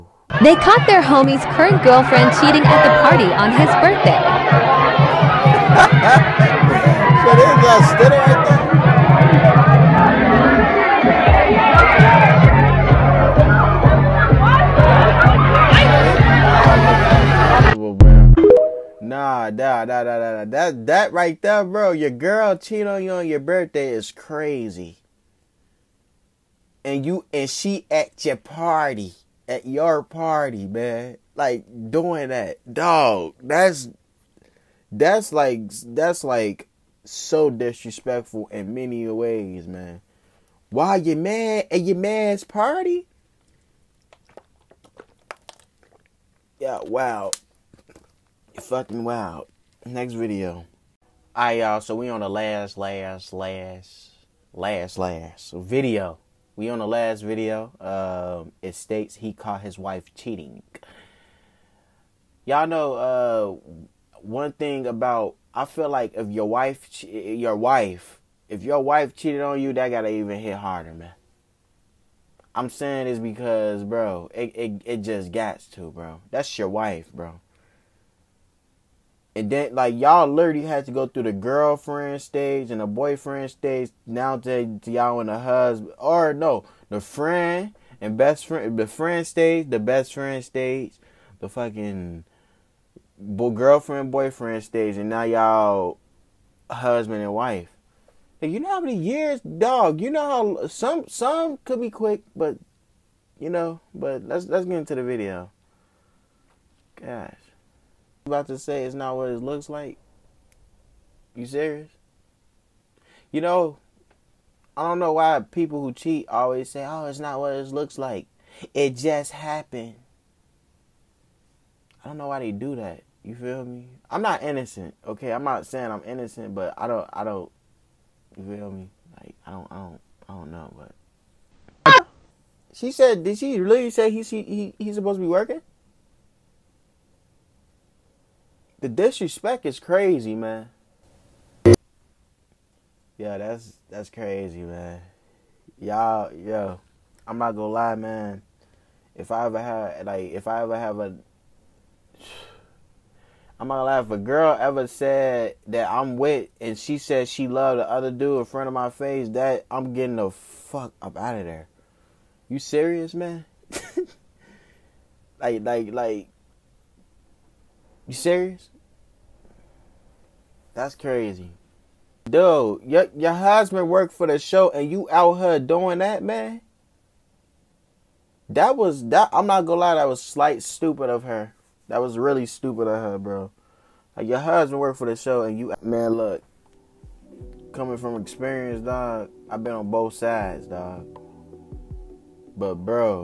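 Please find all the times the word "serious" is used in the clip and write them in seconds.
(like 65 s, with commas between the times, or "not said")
111 s, 162 s, 168 s.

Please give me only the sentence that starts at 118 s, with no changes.
It just happened." I don't know why they do that.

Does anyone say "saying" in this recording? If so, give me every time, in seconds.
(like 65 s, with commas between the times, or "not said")
72 s, 125 s.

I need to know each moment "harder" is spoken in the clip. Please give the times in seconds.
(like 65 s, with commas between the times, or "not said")
70 s.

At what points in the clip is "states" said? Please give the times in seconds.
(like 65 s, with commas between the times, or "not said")
58 s.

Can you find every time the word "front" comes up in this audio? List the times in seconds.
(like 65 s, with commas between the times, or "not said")
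158 s.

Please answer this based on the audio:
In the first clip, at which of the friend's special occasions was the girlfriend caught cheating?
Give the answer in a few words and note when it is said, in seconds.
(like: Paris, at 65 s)
His birthday, at 3 s.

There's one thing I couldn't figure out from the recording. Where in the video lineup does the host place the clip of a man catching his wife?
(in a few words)
The last video.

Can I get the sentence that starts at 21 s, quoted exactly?
Your girl cheating on you on your birthday is crazy and you and she at your party, at your party, man.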